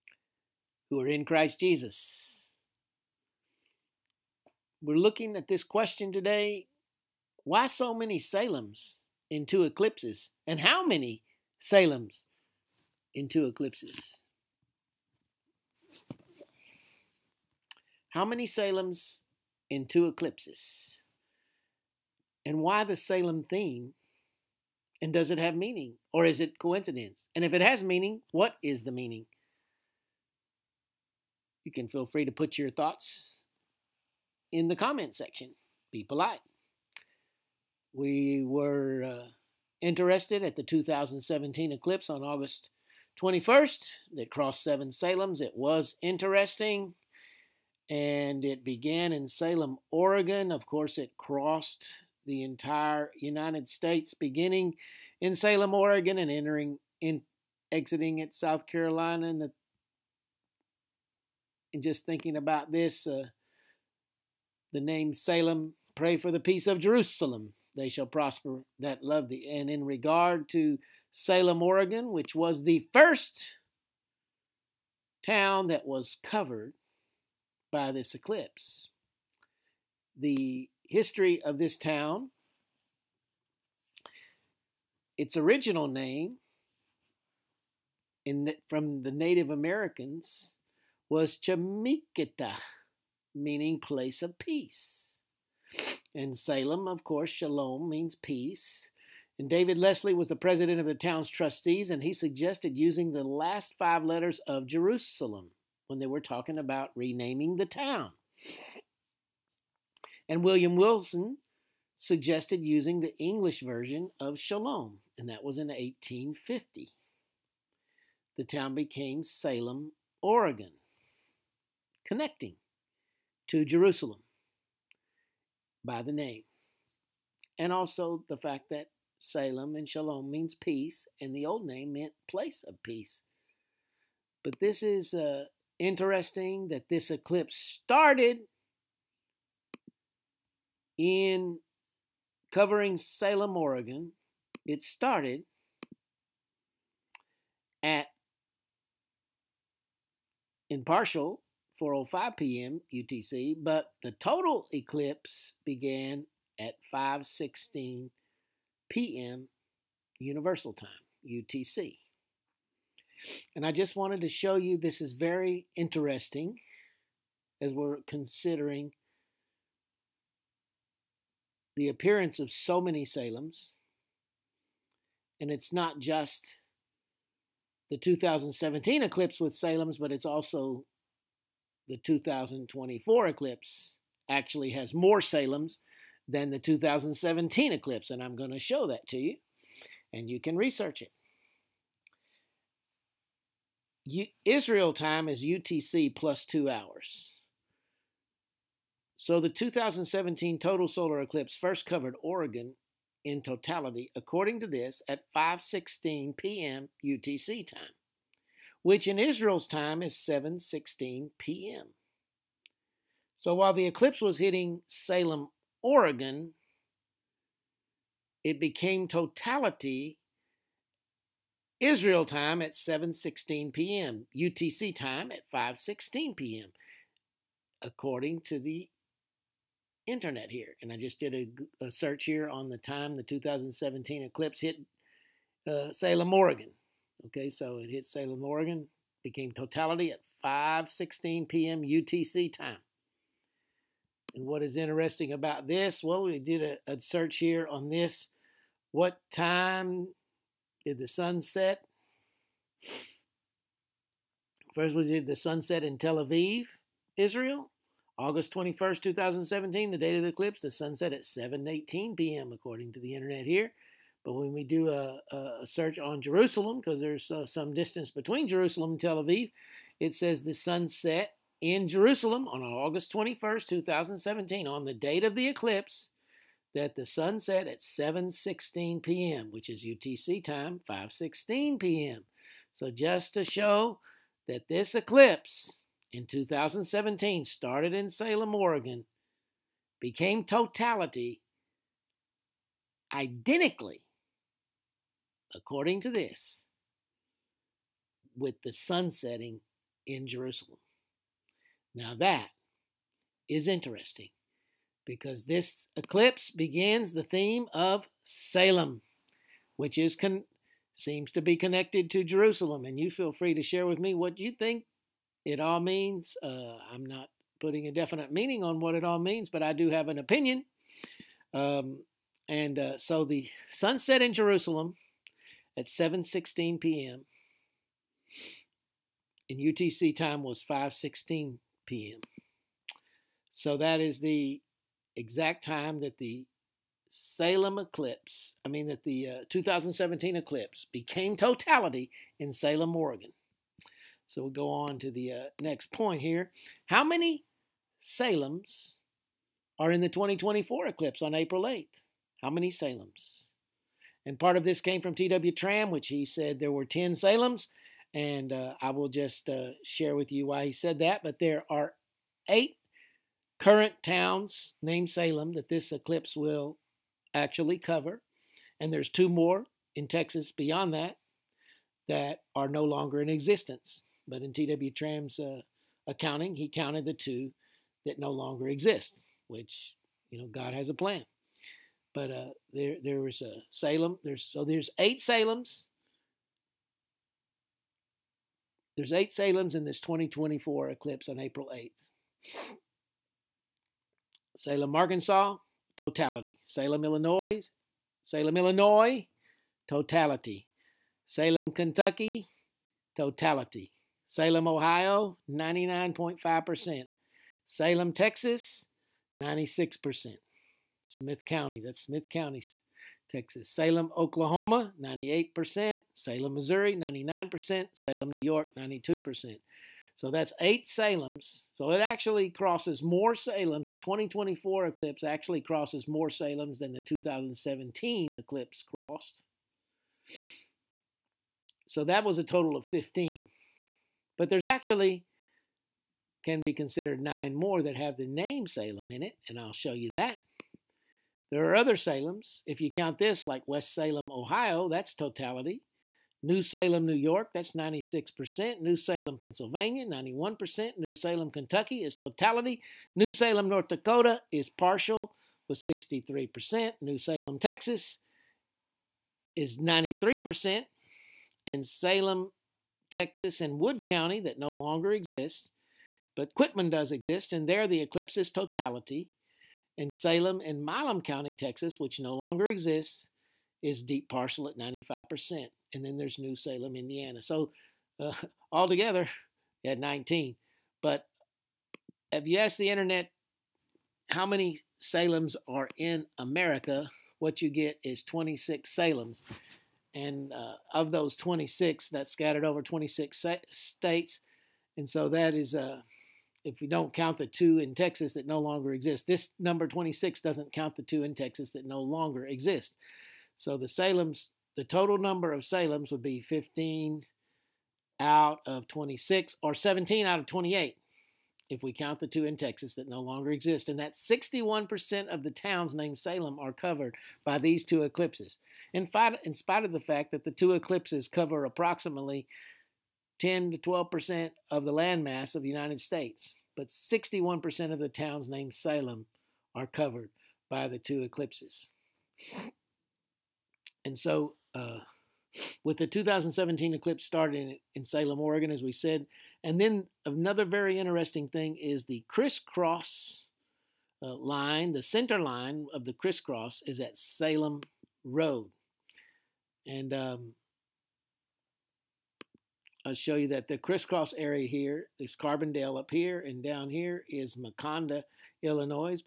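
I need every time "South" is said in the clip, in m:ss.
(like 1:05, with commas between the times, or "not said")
0:58.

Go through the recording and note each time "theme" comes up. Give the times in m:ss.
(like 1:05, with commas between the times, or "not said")
0:23, 5:07.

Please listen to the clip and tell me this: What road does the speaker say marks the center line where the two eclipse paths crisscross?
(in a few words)
Salem Road.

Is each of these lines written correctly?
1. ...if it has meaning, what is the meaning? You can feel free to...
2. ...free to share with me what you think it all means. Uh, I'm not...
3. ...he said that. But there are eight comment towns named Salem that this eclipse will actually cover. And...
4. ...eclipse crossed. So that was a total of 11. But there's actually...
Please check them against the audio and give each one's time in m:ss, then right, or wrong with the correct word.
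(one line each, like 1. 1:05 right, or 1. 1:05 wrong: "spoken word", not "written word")
1. 0:27 right
2. 5:13 right
3. 6:00 wrong: "current", not "comment"
4. 7:08 wrong: "15", not "11".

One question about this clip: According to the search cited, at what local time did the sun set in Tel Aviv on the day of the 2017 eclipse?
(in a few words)
7:18 p.m.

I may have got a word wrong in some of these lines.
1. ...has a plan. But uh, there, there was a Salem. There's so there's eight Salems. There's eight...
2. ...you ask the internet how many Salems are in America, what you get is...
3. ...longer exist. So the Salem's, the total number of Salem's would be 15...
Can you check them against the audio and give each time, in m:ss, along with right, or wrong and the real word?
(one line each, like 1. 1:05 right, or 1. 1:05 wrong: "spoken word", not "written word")
1. 6:20 right
2. 8:02 right
3. 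8:21 right.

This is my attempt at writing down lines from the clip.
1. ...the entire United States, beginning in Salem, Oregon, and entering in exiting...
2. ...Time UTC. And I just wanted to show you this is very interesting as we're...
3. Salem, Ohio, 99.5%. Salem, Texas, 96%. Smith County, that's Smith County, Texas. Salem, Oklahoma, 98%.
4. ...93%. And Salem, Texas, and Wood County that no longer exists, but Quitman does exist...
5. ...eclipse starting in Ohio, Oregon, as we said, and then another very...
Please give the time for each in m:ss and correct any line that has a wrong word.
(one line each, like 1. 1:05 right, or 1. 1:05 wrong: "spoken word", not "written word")
1. 0:52 right
2. 2:40 right
3. 6:44 right
4. 7:39 right
5. 8:56 wrong: "Salem", not "Ohio".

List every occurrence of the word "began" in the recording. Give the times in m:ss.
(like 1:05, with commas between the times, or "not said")
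0:48, 2:35.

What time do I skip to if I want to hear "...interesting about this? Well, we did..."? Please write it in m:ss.
4:04.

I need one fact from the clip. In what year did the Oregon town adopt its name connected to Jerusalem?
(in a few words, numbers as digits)
1850.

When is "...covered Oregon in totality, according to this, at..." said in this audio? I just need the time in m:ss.
3:21.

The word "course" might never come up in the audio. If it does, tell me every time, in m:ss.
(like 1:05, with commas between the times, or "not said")
0:50, 1:37.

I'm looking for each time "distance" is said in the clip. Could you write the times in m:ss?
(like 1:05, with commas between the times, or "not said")
4:27.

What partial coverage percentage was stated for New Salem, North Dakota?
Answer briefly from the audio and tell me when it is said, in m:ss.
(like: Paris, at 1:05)
63%, at 7:35.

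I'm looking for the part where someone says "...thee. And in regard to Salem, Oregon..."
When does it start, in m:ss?
1:09.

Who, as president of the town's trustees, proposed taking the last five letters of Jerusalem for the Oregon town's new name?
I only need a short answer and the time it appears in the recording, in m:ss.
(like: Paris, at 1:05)
David Leslie, at 1:39.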